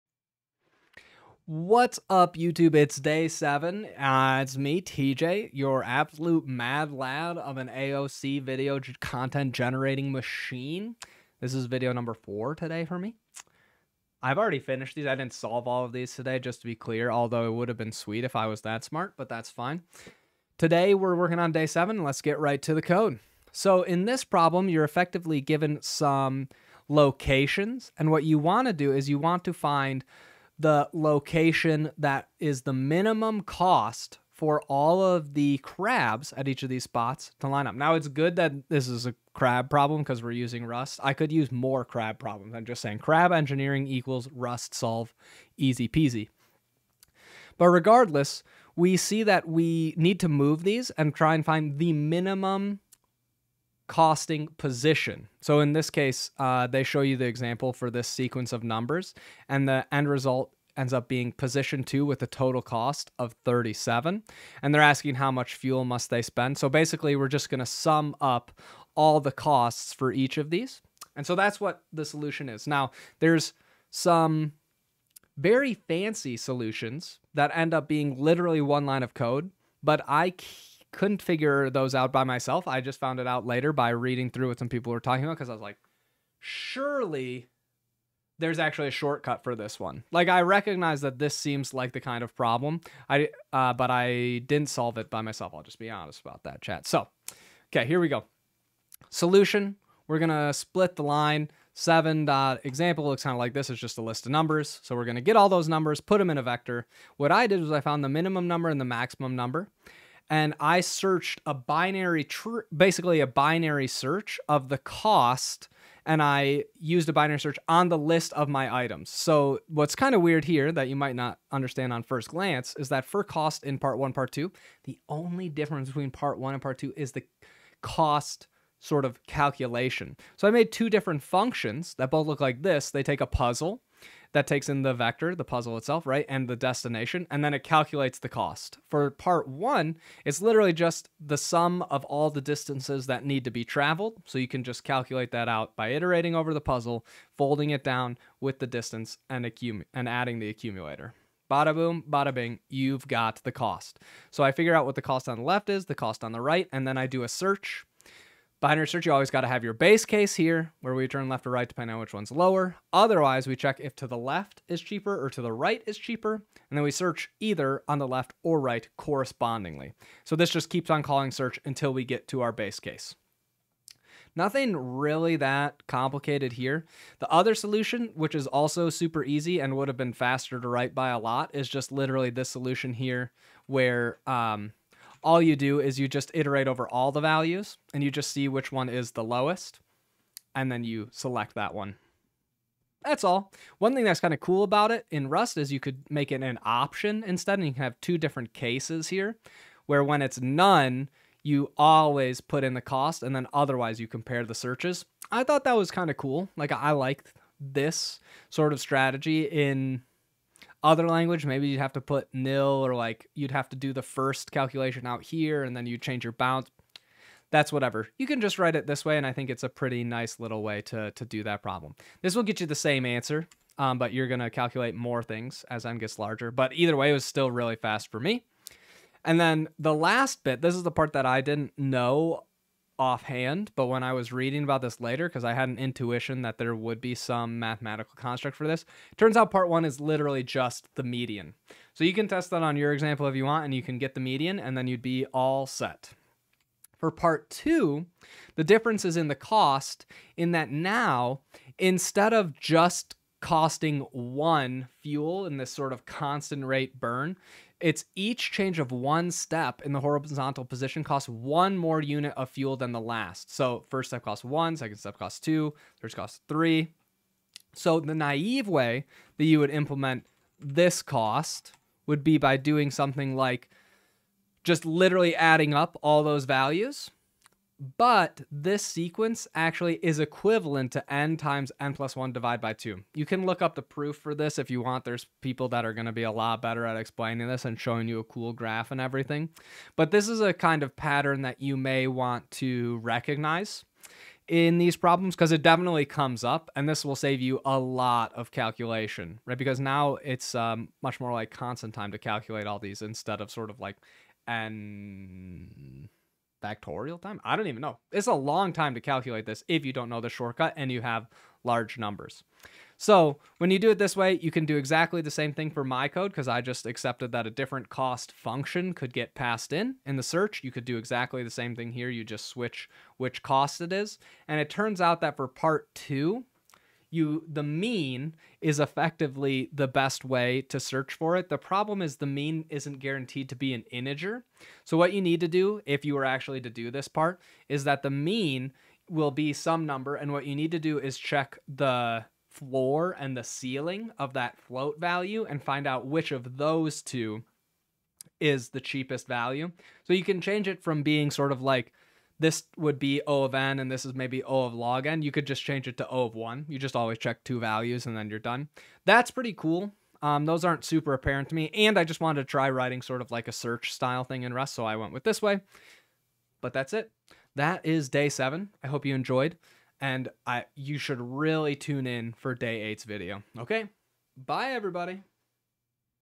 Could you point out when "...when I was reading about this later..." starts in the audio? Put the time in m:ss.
3:53.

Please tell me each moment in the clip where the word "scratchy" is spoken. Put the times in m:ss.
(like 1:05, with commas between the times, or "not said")
not said.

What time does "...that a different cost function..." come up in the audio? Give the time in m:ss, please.
5:17.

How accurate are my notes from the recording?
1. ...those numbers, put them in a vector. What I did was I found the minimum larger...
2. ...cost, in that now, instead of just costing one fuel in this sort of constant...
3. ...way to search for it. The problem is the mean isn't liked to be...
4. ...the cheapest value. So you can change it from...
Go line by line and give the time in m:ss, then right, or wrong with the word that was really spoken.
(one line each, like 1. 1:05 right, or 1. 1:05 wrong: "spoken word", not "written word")
1. 1:45 wrong: "number", not "larger"
2. 4:09 right
3. 5:30 wrong: "guaranteed", not "liked"
4. 5:48 right.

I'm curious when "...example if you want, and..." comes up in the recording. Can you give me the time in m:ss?
4:02.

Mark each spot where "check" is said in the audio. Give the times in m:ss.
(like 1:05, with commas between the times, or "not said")
2:43, 5:41, 5:57.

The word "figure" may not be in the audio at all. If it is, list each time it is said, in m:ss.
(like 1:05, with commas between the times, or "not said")
1:21, 2:34.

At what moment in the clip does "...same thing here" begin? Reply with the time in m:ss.
5:21.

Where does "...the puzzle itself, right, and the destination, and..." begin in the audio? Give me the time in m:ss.
2:15.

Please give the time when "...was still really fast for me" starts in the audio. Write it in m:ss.
3:47.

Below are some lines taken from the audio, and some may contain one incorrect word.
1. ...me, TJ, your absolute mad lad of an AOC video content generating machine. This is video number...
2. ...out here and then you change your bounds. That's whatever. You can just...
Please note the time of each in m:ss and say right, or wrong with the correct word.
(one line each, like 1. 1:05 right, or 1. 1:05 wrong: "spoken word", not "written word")
1. 0:04 right
2. 3:35 right.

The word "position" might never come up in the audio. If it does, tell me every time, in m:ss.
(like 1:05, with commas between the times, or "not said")
0:54, 1:01, 4:20.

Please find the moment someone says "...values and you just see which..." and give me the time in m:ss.
3:07.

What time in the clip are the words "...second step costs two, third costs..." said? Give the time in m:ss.
4:24.